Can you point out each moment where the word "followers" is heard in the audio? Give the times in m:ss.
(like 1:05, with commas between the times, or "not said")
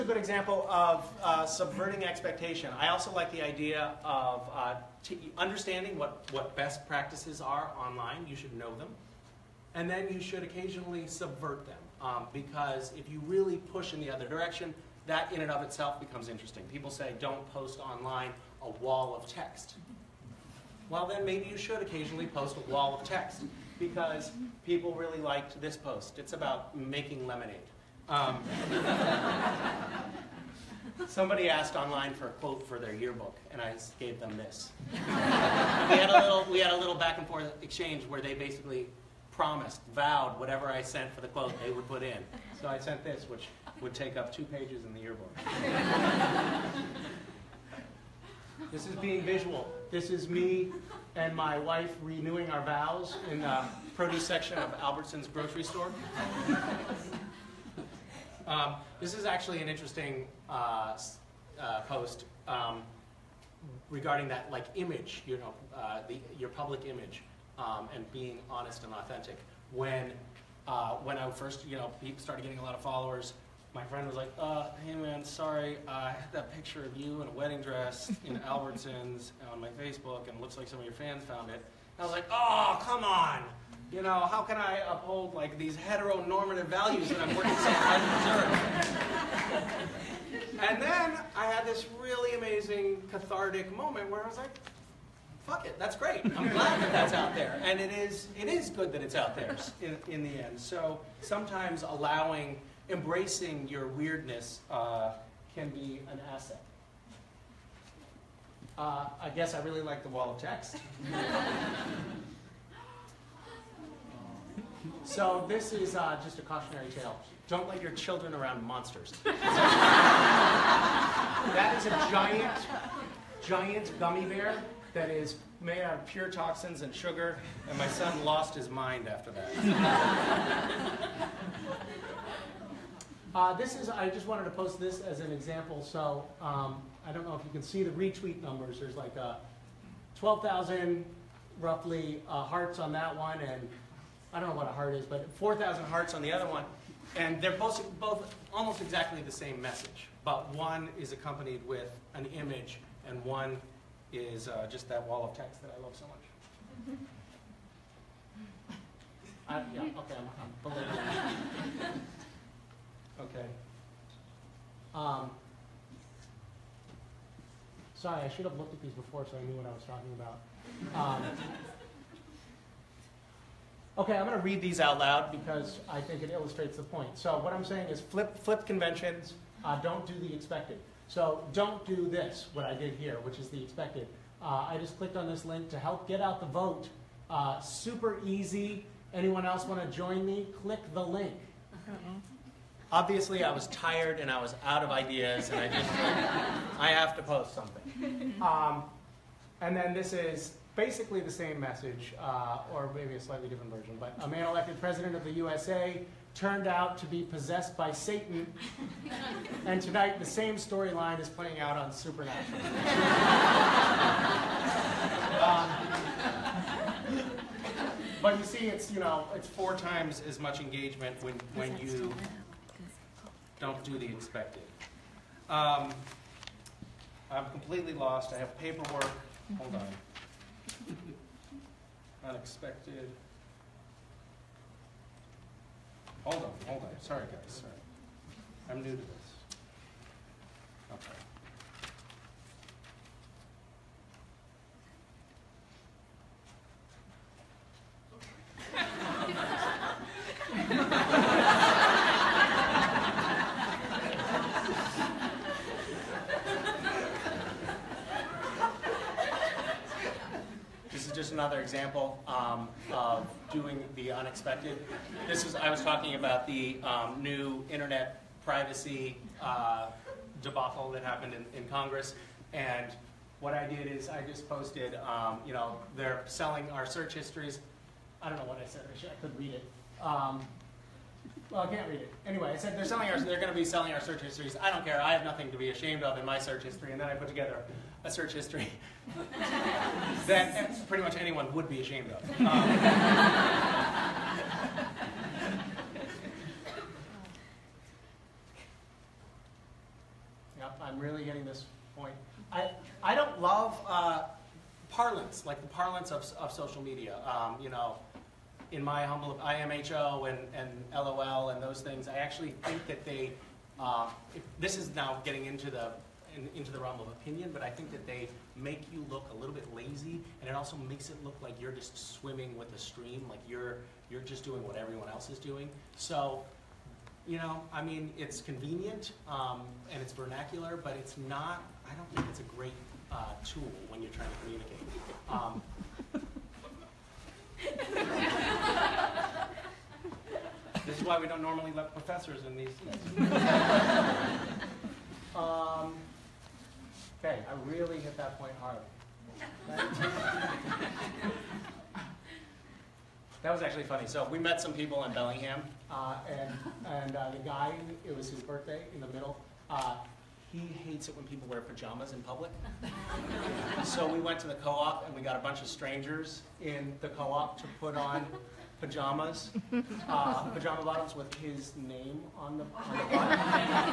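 1:12.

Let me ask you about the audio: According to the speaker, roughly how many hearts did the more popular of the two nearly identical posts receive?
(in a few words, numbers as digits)
12,000.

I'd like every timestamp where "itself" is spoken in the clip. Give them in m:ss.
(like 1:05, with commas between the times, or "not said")
0:15.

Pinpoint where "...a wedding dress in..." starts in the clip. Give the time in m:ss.
1:17.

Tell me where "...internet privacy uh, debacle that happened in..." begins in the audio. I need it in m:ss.
4:27.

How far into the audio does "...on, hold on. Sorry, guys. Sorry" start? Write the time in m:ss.
3:56.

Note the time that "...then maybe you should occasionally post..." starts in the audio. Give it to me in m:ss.
0:21.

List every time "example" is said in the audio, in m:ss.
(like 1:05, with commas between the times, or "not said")
0:00, 2:15, 4:21.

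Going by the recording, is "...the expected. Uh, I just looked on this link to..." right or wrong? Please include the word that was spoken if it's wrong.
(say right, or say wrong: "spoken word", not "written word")
wrong: "clicked", not "looked".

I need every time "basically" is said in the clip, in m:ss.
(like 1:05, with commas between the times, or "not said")
0:38, 3:20.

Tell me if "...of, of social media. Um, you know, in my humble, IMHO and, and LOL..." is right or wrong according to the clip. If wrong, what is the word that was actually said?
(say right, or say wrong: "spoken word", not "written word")
right.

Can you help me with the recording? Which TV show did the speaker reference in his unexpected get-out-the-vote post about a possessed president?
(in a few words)
Supernatural.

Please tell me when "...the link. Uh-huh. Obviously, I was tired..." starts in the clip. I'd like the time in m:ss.
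3:10.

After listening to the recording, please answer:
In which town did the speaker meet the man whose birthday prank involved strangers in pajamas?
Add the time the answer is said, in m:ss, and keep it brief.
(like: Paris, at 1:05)
Bellingham, at 5:55.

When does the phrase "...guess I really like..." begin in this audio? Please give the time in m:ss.
1:49.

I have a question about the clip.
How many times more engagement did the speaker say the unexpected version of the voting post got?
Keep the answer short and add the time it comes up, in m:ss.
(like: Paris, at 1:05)
4 times, at 3:39.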